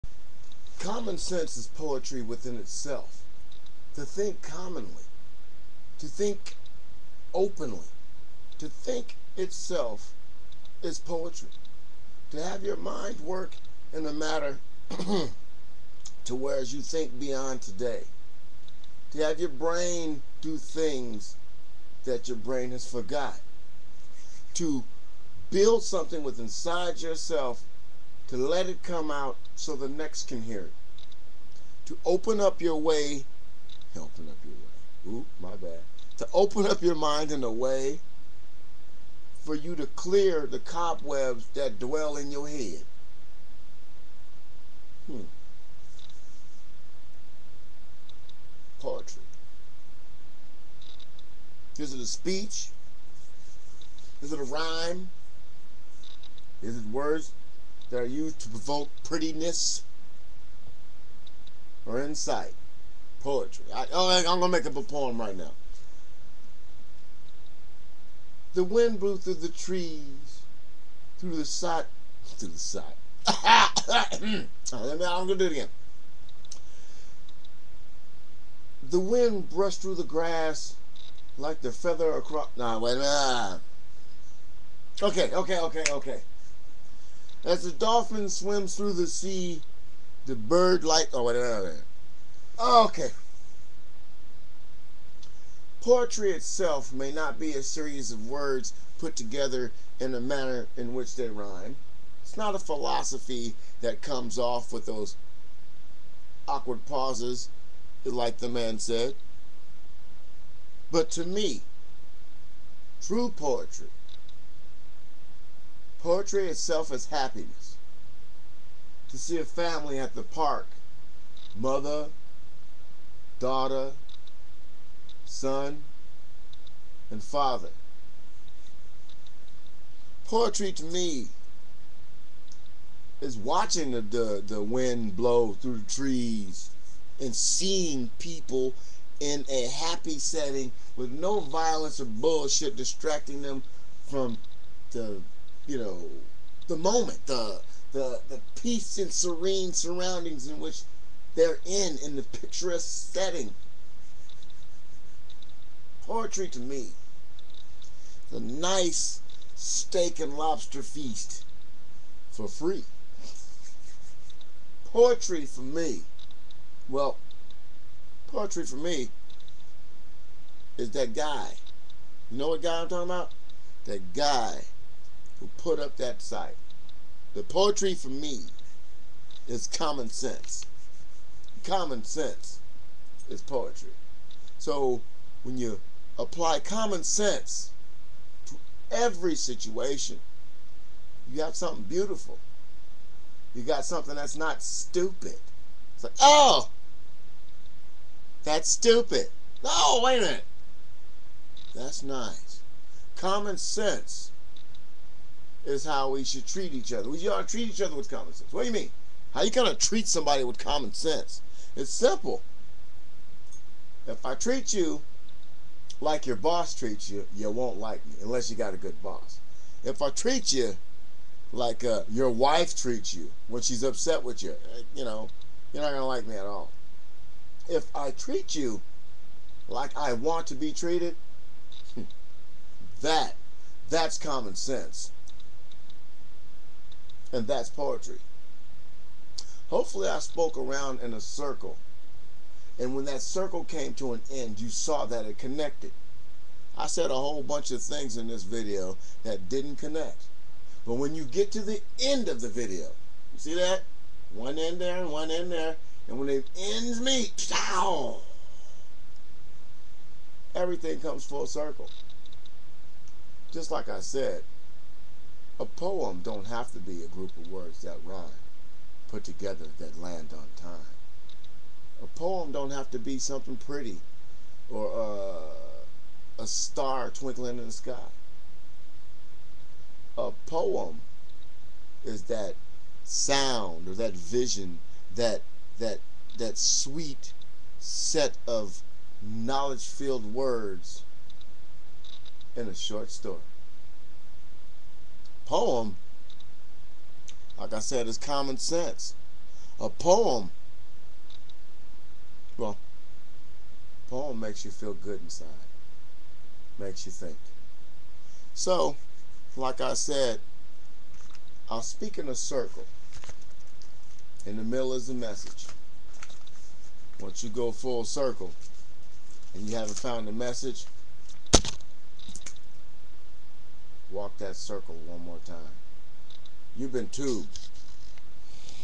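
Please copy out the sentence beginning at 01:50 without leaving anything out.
But to me, true poetry Poetry itself is happiness.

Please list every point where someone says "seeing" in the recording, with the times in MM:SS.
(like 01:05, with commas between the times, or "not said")
02:17.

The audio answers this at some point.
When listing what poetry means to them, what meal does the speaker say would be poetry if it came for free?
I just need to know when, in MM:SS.
02:39.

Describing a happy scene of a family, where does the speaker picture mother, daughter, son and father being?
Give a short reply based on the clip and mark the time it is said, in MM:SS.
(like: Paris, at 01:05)
the park, at 02:00.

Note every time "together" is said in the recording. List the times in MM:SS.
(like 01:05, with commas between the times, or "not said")
01:39, 04:29.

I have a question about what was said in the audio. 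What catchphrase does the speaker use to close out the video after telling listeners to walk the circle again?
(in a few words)
You've been tubed.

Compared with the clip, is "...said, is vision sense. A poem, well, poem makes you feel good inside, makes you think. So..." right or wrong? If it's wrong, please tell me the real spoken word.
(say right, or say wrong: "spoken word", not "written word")
wrong: "common", not "vision".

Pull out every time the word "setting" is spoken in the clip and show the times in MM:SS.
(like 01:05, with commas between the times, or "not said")
02:20, 02:33.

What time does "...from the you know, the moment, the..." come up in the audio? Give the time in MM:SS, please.
02:24.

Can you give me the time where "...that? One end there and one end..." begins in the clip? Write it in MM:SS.
04:13.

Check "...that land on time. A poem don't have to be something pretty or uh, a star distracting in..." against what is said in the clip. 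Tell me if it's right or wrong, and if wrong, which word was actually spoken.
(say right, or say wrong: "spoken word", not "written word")
wrong: "twinkling", not "distracting".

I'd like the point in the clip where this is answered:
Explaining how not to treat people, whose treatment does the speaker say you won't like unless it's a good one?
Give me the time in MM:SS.
03:36.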